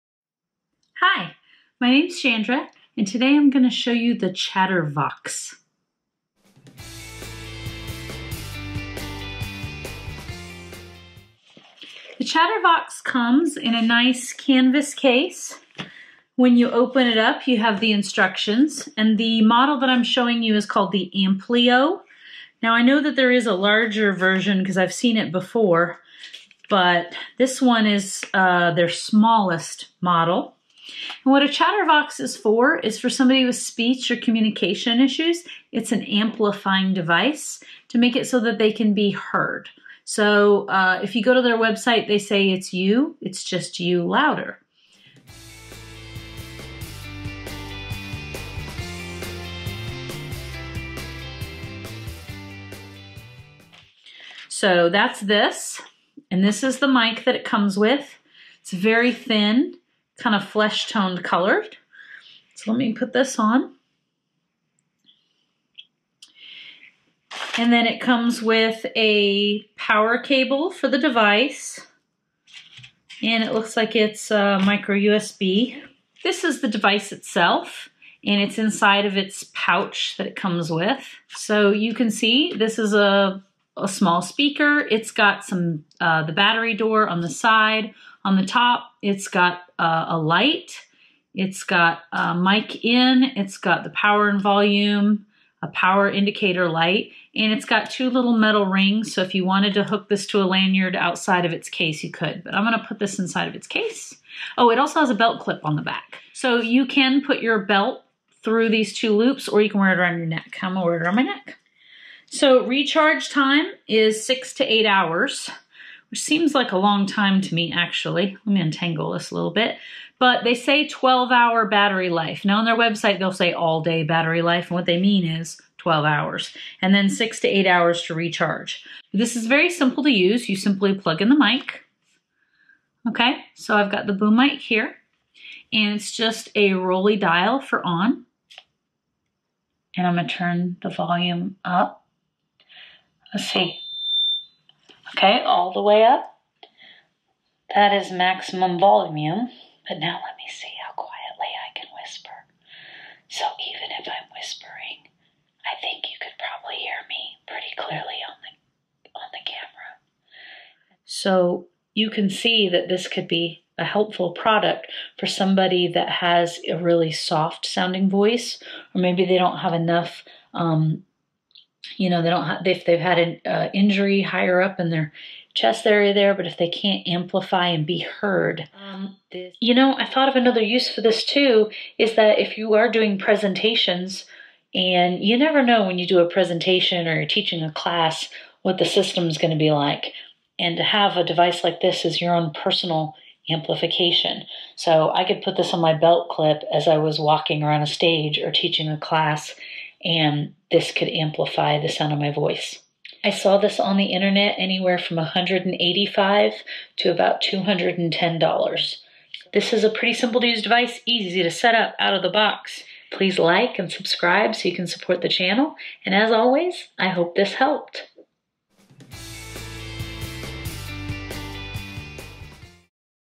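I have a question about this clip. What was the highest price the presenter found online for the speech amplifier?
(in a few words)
$210.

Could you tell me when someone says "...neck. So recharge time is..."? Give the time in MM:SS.
01:51.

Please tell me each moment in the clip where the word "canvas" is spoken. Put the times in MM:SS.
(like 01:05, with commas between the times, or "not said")
00:14.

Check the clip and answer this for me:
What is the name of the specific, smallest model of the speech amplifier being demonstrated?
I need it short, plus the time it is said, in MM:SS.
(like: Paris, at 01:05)
Amplio, at 00:21.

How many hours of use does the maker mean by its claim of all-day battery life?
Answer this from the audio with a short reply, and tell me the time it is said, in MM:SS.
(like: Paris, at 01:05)
12 hours, at 02:00.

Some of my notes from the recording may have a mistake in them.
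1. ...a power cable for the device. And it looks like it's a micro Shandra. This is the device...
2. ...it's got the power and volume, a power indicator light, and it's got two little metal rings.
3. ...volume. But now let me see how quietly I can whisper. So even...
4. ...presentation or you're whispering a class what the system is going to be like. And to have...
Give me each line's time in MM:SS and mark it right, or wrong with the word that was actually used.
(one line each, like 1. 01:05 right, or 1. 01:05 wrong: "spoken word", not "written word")
1. 01:08 wrong: "USB", not "Shandra"
2. 01:33 right
3. 02:28 right
4. 03:06 wrong: "teaching", not "whispering".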